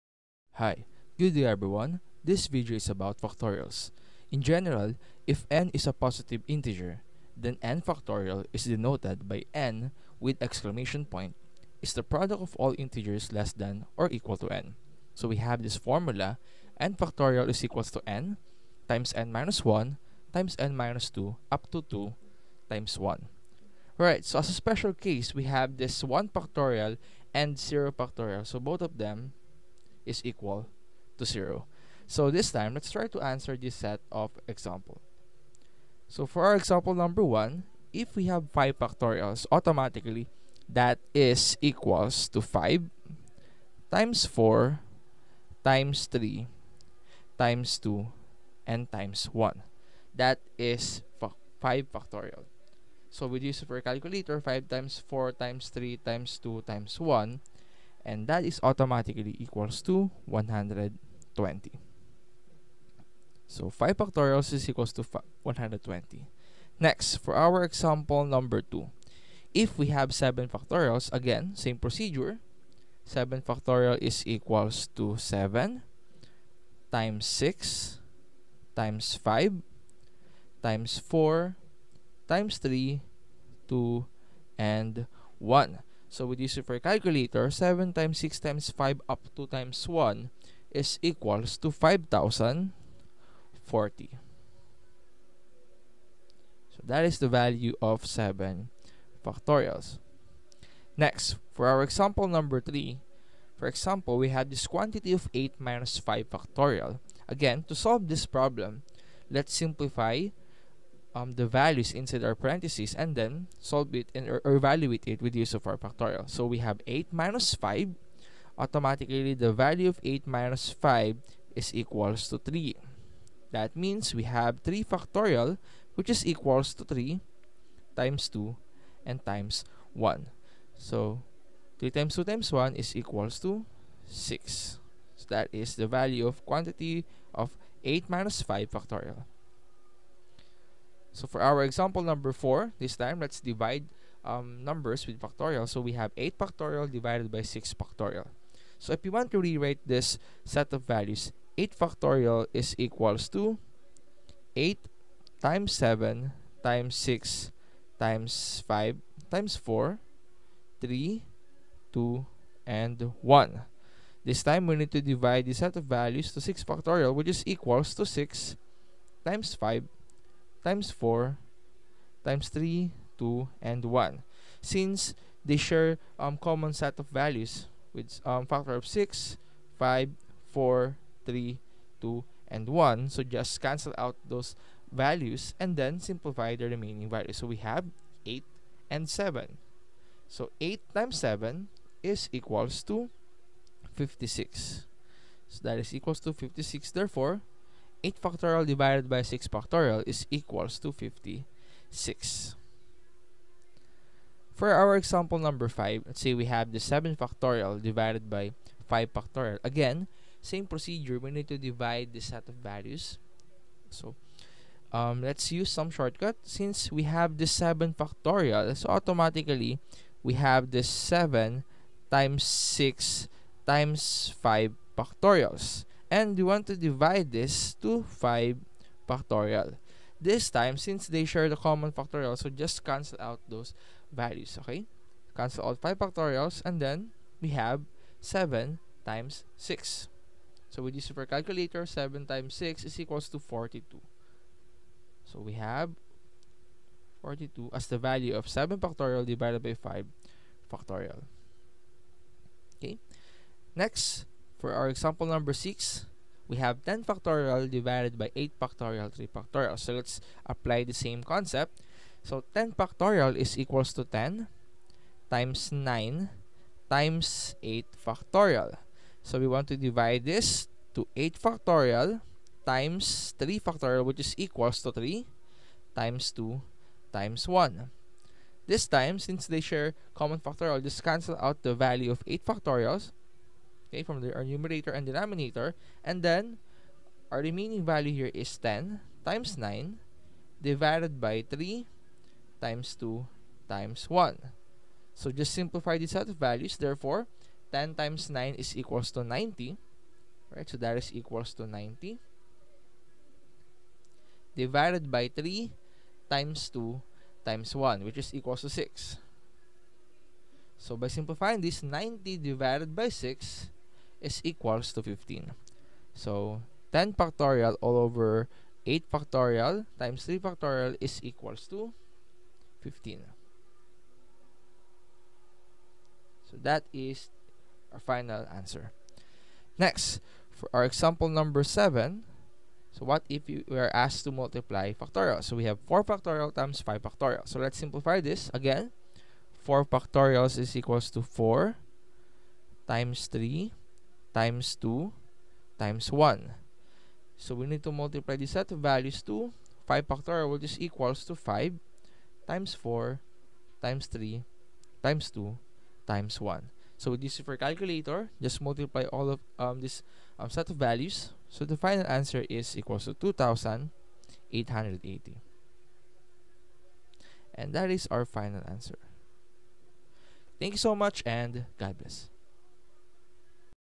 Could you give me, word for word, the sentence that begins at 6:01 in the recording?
So the final answer is equals to 2,880.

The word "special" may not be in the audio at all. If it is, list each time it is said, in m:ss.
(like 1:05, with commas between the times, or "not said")
0:24.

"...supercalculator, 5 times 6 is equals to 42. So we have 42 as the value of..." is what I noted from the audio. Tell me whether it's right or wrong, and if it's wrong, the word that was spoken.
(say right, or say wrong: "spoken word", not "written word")
wrong: "7", not "5".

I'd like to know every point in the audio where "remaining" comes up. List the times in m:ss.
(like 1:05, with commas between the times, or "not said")
3:06, 4:47.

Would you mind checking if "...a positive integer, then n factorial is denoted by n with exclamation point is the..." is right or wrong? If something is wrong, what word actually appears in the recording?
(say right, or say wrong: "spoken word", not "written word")
right.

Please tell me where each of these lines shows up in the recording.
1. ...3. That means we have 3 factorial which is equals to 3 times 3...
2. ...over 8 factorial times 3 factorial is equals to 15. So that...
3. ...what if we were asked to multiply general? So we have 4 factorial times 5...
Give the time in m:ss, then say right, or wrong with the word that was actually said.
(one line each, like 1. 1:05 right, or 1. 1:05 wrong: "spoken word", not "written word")
1. 2:02 wrong: "2", not "3"
2. 5:17 right
3. 5:33 wrong: "factorial", not "general".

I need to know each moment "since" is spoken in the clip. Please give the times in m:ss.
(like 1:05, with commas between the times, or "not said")
2:54, 3:36, 3:50, 4:39.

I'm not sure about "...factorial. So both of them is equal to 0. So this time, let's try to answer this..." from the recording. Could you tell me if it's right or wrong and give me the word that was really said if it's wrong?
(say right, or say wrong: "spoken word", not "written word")
right.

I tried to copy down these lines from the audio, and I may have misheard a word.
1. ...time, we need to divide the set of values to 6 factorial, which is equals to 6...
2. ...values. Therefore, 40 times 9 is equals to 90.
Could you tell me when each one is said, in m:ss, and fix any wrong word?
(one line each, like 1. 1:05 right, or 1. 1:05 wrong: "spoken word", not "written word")
1. 2:44 right
2. 4:56 wrong: "10", not "40".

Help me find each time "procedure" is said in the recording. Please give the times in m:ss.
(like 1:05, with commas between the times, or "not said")
1:11, 3:30.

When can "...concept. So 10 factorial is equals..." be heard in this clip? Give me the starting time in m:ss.
4:21.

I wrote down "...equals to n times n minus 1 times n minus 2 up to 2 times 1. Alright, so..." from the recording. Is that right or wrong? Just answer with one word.
right.